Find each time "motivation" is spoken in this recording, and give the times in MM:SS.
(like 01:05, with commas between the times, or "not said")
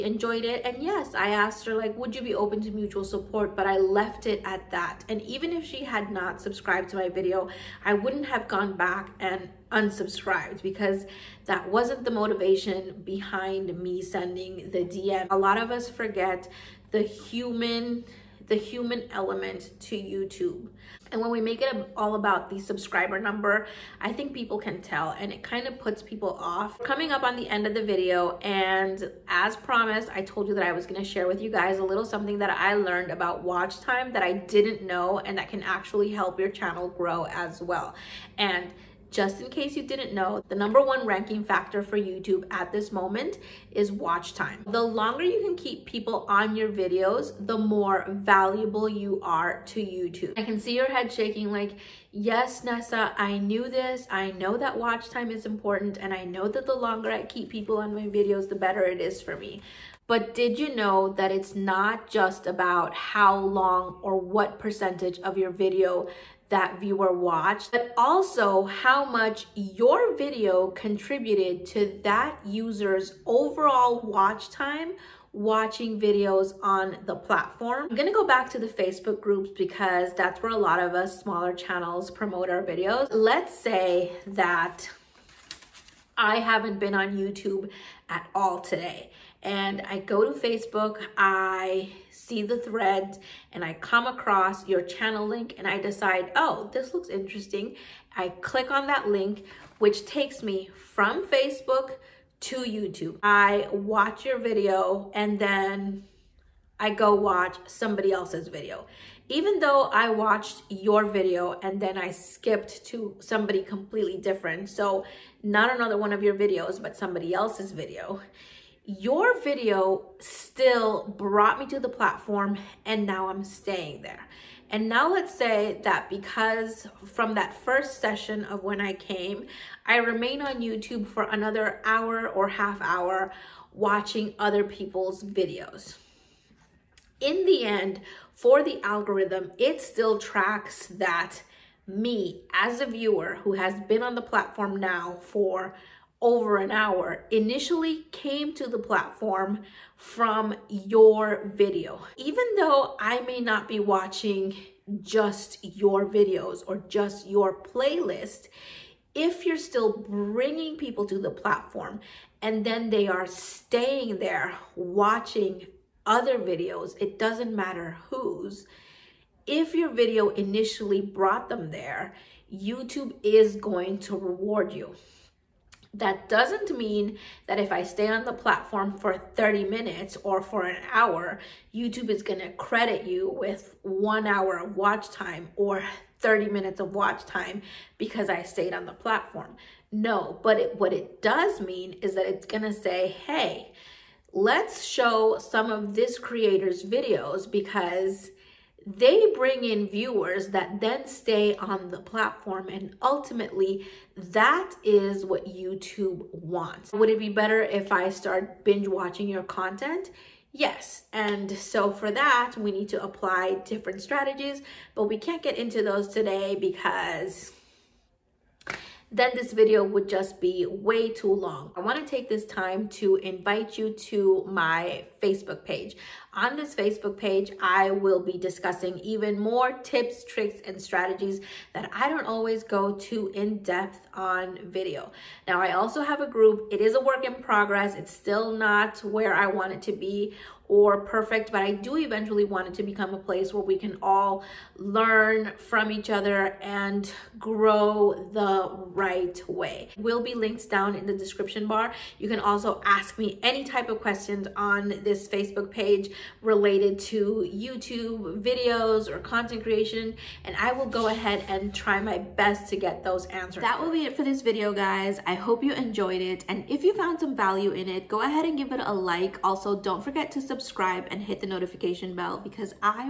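00:12.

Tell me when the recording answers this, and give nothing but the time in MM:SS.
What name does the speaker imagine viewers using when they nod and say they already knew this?
00:52.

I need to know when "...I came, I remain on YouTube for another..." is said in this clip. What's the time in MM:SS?
02:08.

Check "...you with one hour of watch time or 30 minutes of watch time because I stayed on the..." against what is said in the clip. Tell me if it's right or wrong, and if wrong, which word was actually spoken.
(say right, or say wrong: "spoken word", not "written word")
right.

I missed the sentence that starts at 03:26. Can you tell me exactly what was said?
Would it be better if I start binge watching your content?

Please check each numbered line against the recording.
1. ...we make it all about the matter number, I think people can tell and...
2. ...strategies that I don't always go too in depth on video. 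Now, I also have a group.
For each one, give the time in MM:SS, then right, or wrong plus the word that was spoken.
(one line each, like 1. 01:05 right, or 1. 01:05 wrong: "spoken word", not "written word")
1. 00:21 wrong: "subscriber", not "matter"
2. 03:50 right.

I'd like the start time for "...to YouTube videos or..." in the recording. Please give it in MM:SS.
04:16.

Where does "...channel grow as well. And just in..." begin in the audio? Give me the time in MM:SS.
00:36.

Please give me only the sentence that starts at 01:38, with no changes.
I click on that link, which takes me from Facebook to YouTube.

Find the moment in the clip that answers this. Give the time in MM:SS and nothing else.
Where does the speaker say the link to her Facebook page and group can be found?
04:11.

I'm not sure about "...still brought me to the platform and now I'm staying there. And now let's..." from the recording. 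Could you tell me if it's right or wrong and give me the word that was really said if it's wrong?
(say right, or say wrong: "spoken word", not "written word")
right.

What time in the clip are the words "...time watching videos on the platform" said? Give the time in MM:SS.
01:14.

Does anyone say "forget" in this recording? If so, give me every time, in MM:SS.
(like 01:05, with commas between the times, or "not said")
00:15, 04:30.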